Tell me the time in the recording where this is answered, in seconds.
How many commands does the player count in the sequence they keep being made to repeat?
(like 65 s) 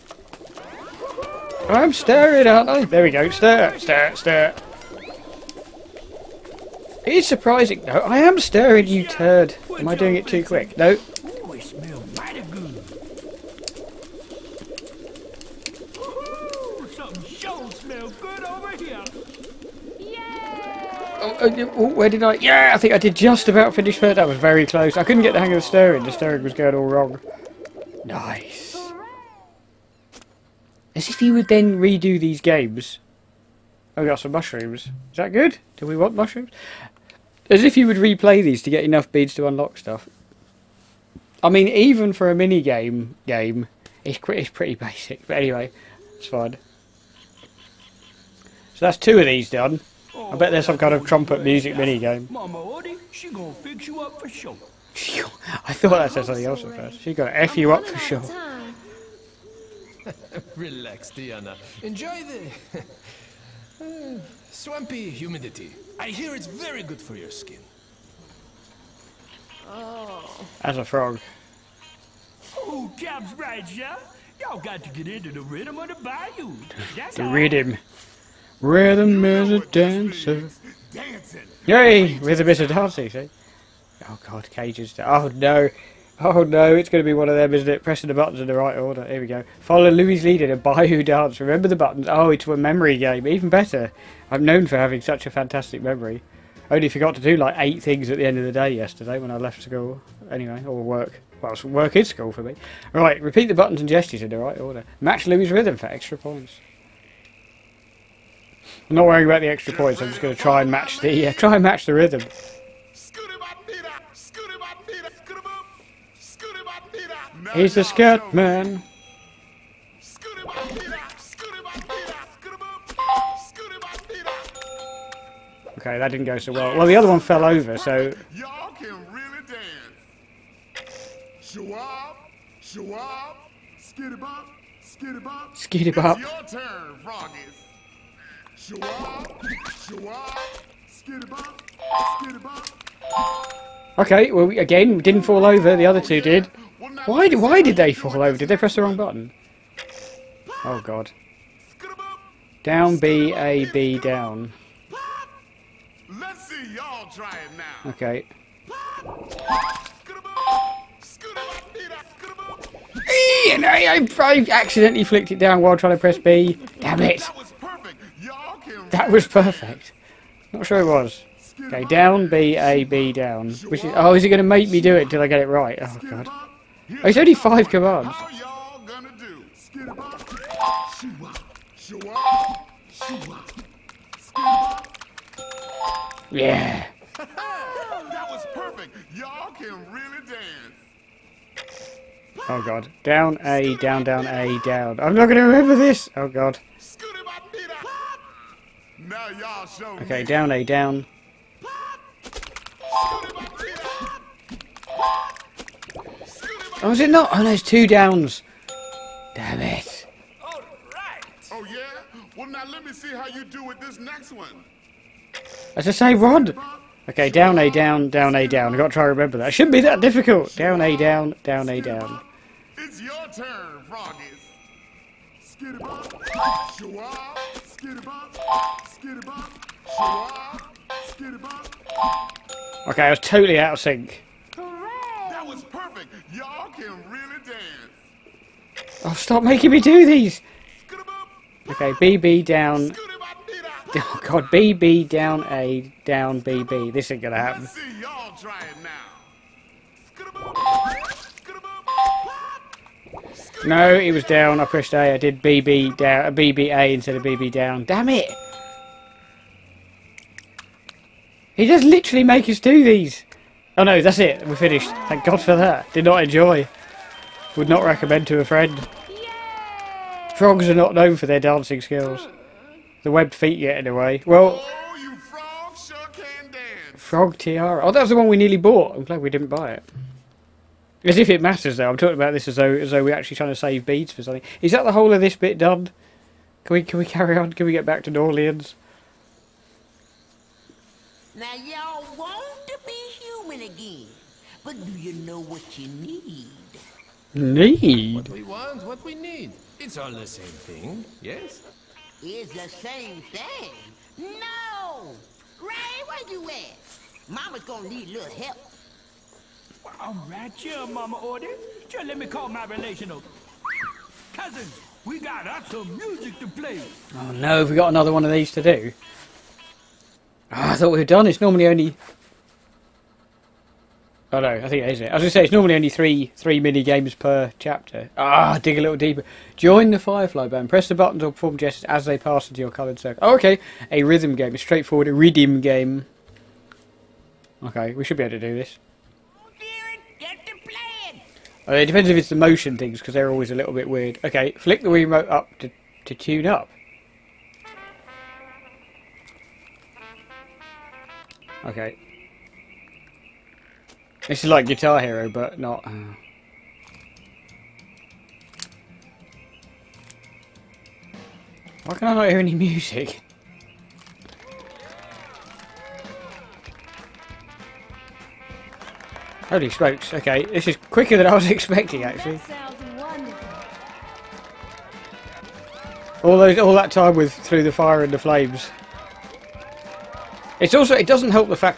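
177 s.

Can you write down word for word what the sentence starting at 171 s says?
Okay, down, B, A, B, down.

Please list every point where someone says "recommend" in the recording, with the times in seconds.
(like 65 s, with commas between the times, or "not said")
267 s.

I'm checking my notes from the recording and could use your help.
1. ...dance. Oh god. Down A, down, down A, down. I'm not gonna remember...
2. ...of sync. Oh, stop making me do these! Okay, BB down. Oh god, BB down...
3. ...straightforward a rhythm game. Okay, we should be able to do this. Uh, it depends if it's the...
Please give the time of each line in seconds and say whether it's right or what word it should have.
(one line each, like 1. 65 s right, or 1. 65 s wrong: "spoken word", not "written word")
1. 190 s right
2. 233 s right
3. 334 s right.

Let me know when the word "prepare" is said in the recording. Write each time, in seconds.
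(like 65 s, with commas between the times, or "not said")
not said.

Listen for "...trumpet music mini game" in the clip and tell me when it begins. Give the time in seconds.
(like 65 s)
51 s.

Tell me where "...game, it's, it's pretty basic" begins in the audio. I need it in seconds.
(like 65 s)
43 s.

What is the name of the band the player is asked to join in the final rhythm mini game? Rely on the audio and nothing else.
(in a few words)
Firefly Band.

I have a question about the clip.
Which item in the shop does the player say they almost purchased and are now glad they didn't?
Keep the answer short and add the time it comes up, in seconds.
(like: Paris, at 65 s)
Frog Tiara, at 276 s.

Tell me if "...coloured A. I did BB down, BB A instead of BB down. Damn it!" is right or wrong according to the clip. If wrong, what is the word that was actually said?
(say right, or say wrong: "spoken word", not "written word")
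wrong: "pressed", not "coloured".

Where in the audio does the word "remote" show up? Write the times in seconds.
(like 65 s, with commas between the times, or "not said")
344 s.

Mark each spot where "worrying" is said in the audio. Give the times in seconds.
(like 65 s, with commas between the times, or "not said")
109 s.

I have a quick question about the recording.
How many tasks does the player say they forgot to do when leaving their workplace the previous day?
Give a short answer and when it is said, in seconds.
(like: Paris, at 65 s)
8, at 97 s.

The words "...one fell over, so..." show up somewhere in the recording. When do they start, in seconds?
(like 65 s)
127 s.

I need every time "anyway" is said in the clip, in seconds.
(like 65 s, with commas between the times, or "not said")
45 s, 100 s.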